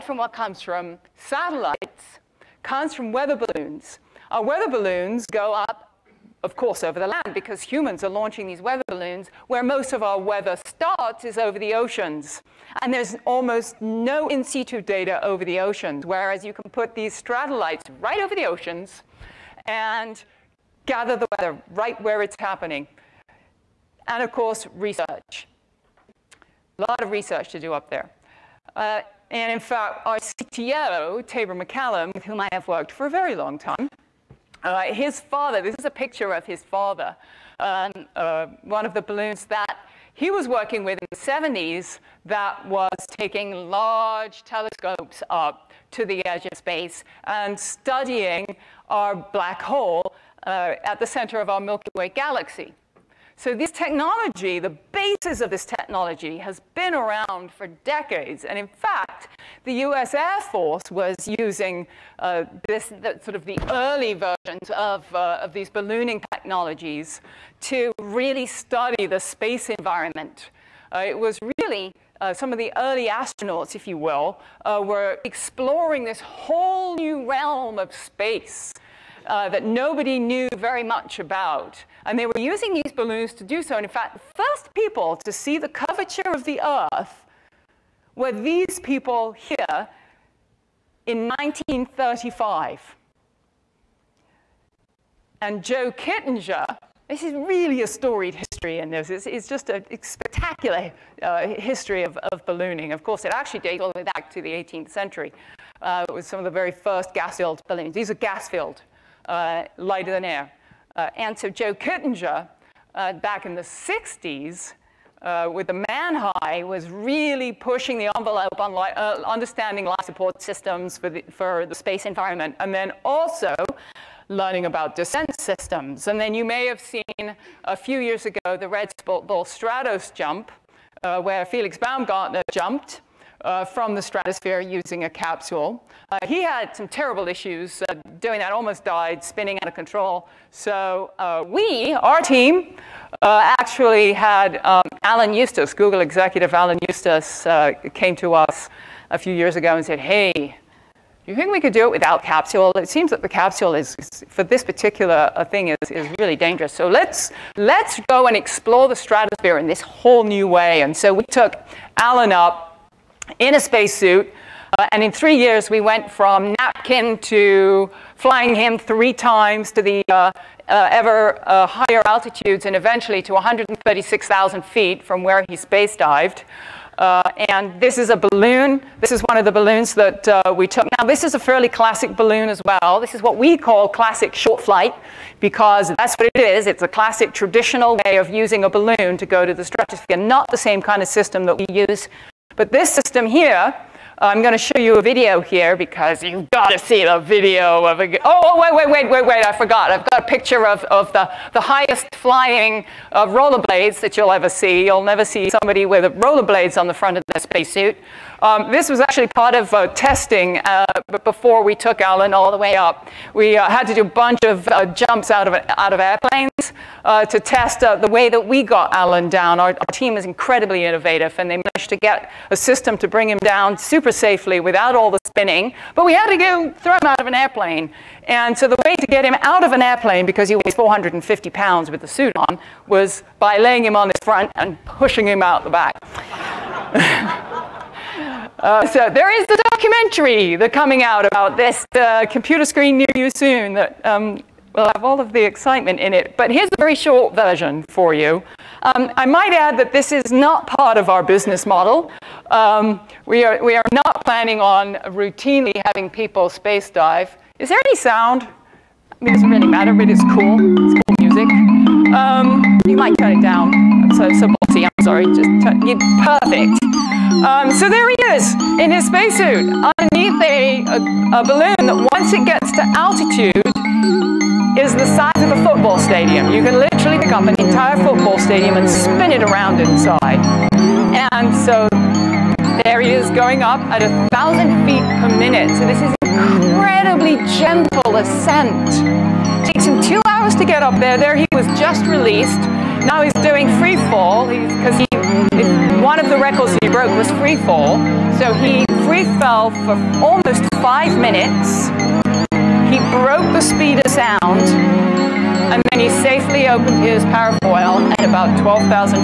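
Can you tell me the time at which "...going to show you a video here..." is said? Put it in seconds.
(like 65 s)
194 s.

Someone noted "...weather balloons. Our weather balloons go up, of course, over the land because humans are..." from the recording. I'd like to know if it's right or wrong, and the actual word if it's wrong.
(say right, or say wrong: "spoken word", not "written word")
right.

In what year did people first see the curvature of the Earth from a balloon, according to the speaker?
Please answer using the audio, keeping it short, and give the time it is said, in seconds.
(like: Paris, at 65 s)
1935, at 91 s.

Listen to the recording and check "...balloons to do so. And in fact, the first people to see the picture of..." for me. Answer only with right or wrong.
wrong.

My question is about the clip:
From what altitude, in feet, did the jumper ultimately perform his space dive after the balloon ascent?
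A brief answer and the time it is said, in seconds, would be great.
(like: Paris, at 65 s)
136,000 feet, at 173 s.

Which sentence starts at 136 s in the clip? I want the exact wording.
Uh, he had some terrible issues uh, doing that, almost died, spinning out of control.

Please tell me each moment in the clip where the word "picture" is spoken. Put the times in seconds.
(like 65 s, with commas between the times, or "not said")
35 s, 200 s.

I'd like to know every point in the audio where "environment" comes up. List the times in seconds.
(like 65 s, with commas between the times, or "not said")
69 s, 122 s.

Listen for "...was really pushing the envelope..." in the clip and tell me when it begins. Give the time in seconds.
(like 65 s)
116 s.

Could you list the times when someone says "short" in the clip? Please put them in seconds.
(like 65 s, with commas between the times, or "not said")
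184 s, 246 s.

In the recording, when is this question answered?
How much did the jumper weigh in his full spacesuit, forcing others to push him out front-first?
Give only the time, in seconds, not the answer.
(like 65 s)
230 s.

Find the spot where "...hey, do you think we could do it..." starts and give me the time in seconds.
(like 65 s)
149 s.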